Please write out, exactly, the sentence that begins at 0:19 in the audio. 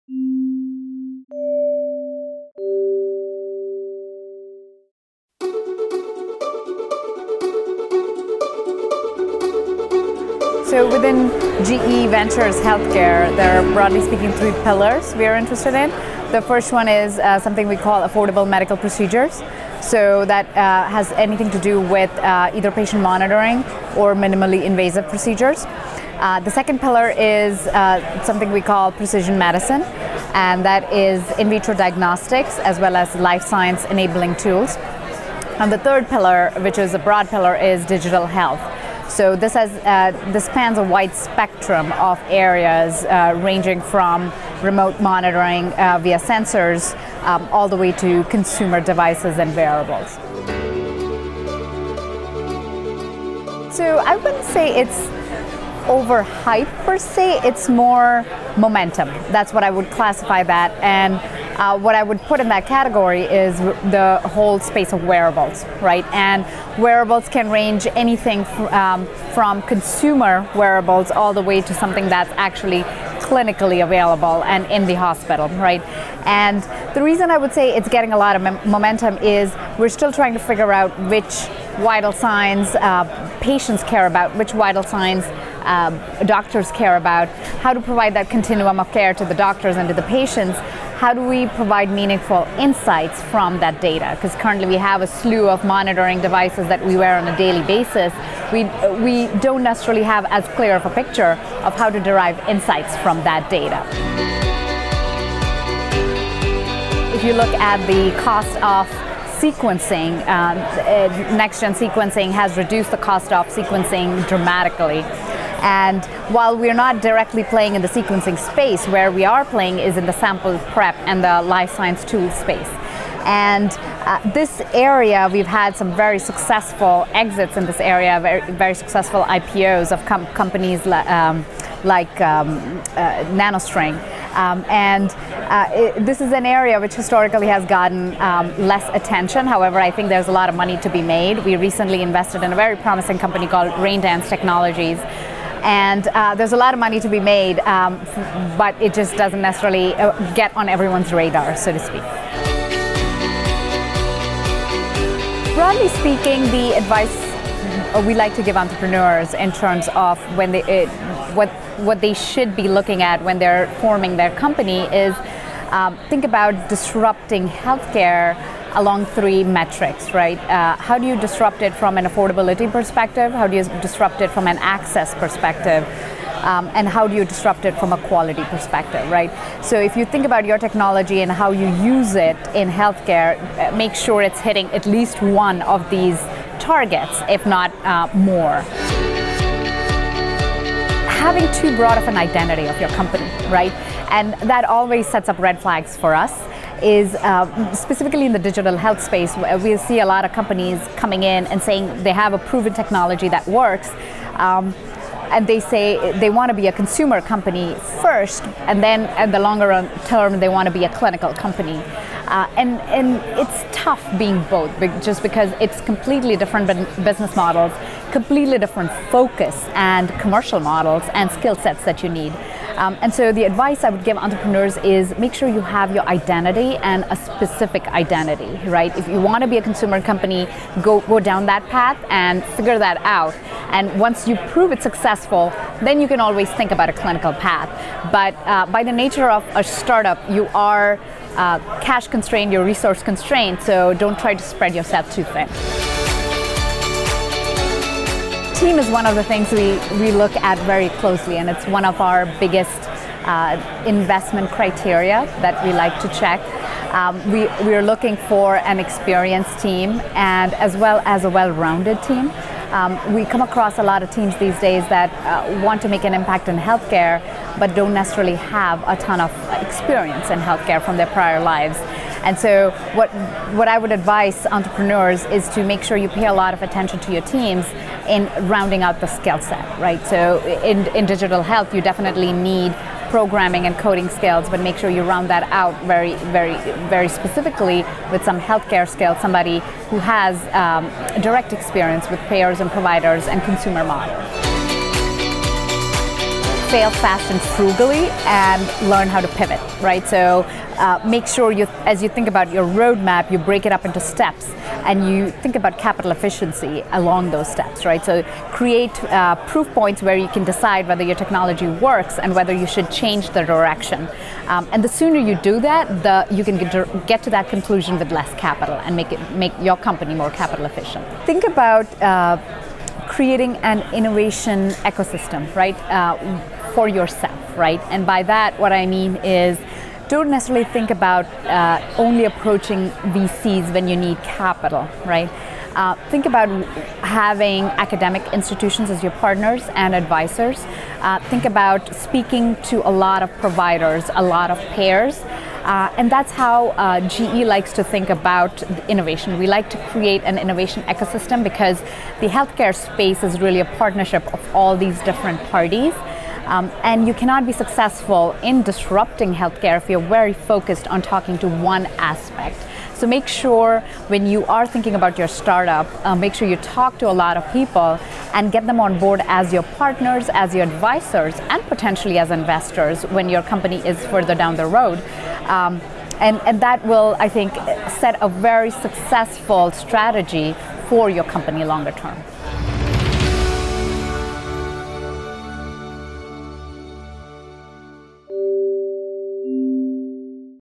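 So that uh, has anything to do with uh, either patient monitoring or minimally invasive procedures.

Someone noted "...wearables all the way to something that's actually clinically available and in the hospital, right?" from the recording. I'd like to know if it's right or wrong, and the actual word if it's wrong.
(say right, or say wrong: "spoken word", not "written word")
right.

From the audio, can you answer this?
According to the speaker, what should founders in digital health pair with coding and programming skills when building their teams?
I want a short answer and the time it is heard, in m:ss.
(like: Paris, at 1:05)
Healthcare skills, at 4:48.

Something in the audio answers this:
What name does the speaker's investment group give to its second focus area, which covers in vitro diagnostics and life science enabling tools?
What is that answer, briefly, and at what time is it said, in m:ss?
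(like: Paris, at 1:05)
Precision medicine, at 0:28.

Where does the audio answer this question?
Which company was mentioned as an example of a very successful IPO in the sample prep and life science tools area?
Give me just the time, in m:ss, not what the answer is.
2:13.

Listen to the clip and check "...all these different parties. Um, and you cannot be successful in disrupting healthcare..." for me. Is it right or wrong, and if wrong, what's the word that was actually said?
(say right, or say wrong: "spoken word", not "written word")
right.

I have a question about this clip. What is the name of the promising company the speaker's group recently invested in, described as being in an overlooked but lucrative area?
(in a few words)
Raindance Technologies.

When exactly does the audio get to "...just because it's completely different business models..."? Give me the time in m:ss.
3:35.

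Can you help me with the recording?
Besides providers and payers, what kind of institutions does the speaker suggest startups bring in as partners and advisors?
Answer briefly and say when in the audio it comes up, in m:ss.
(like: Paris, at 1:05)
Academic institutions, at 5:37.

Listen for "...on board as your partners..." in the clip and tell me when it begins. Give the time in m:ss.
6:08.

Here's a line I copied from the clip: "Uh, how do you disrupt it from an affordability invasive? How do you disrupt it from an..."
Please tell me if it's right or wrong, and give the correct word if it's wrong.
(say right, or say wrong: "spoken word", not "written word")
wrong: "perspective", not "invasive".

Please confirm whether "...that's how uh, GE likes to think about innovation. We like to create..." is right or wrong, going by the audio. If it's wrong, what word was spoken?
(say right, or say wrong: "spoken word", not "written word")
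right.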